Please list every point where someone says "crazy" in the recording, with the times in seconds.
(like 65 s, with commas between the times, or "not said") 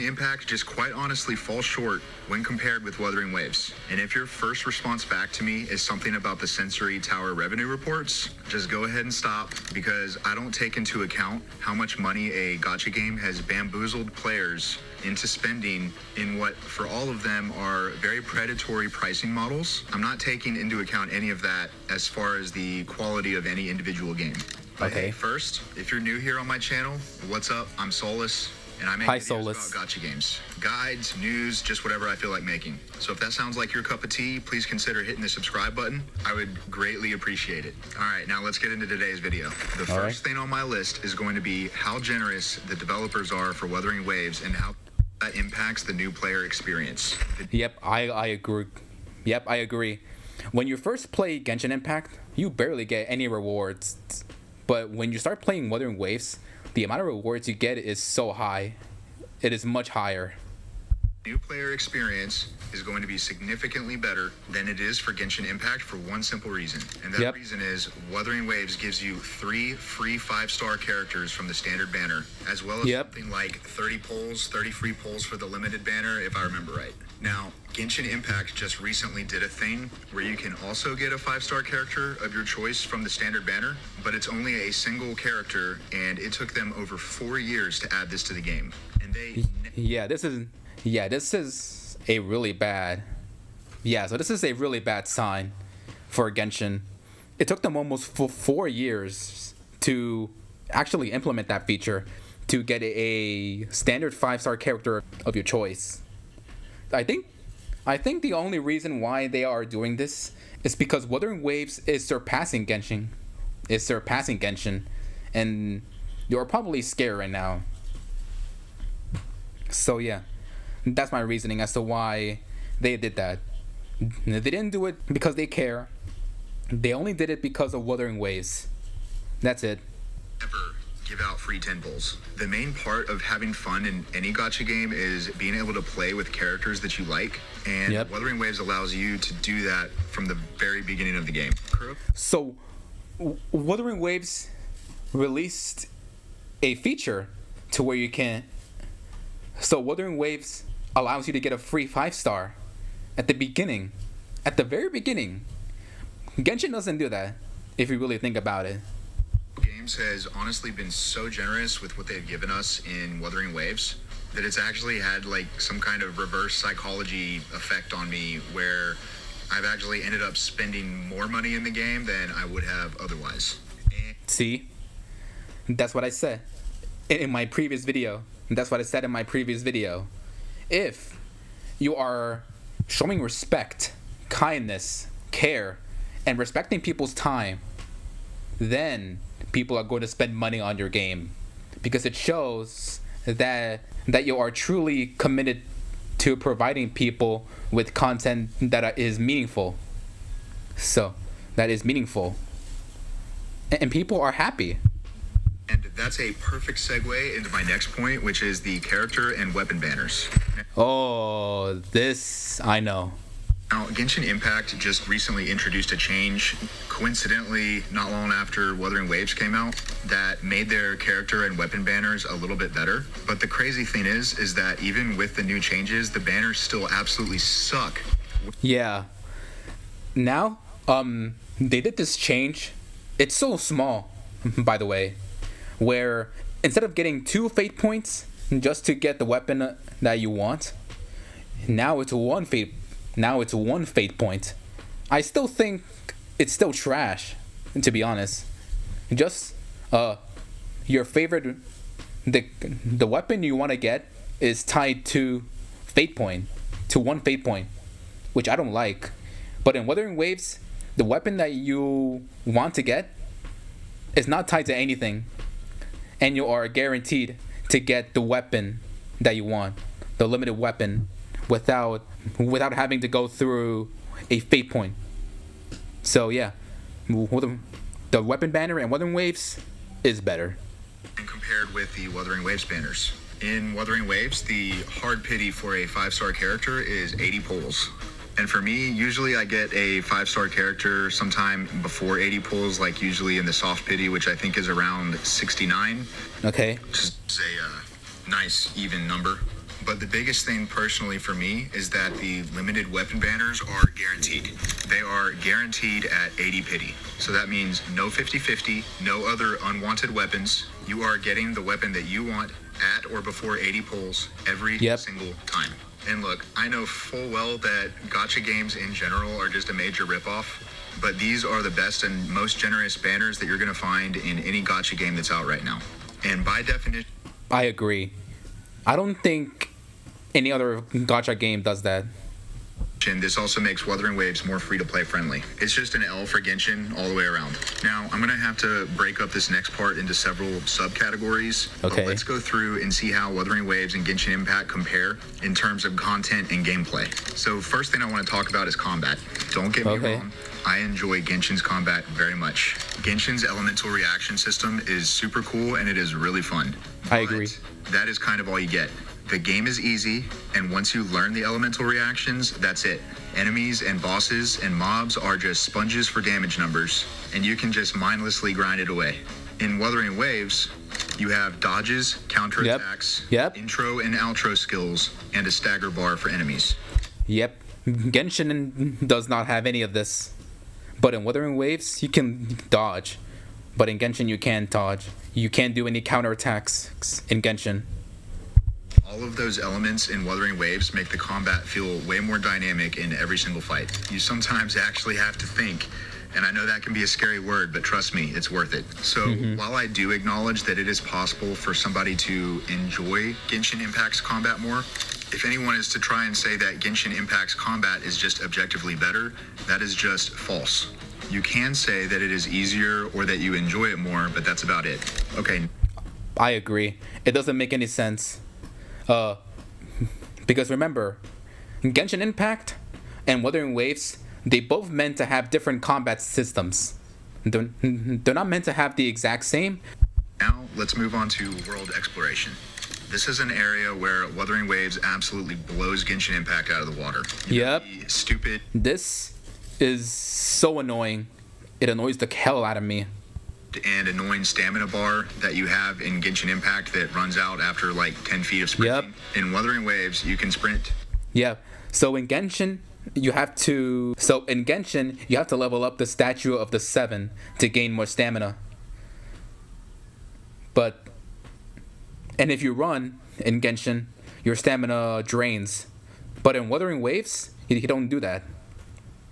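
223 s.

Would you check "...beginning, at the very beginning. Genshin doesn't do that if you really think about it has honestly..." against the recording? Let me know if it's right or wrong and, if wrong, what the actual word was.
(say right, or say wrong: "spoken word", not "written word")
right.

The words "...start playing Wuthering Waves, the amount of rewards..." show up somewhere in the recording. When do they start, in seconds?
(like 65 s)
55 s.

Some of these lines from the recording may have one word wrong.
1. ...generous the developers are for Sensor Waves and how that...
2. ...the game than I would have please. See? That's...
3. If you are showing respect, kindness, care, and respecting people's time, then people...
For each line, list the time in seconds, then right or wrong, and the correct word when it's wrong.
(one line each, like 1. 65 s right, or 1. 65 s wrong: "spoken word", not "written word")
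1. 42 s wrong: "Wuthering", not "Sensor"
2. 171 s wrong: "otherwise", not "please"
3. 180 s right.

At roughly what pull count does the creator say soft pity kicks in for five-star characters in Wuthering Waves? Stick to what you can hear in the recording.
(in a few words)
69.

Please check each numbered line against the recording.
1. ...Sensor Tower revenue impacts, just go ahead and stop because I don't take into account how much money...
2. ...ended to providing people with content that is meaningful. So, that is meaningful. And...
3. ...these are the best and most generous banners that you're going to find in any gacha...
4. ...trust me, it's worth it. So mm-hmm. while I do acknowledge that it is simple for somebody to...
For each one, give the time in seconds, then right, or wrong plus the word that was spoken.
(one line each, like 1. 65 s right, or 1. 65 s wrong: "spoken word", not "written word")
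1. 6 s wrong: "reports", not "impacts"
2. 195 s wrong: "committed", not "ended"
3. 321 s right
4. 397 s wrong: "possible", not "simple".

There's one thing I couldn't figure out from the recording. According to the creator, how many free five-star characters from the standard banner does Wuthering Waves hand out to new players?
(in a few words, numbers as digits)
3.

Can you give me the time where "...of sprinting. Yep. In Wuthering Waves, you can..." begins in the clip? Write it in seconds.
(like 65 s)
448 s.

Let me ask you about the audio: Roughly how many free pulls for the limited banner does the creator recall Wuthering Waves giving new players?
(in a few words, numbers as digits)
30.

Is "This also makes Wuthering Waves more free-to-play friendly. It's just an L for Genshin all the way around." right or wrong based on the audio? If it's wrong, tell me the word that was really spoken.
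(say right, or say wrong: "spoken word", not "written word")
right.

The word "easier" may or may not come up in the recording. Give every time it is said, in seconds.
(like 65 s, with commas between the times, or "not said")
412 s.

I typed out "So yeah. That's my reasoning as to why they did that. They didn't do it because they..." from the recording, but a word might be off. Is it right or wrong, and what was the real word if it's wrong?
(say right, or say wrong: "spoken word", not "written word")
right.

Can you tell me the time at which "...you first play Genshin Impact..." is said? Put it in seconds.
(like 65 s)
50 s.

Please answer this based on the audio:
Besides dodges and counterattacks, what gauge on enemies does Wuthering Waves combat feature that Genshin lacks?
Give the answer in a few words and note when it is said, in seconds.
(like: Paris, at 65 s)
stagger bar, at 375 s.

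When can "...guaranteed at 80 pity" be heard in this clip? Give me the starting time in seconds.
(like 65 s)
305 s.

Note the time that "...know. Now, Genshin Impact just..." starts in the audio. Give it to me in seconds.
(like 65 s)
212 s.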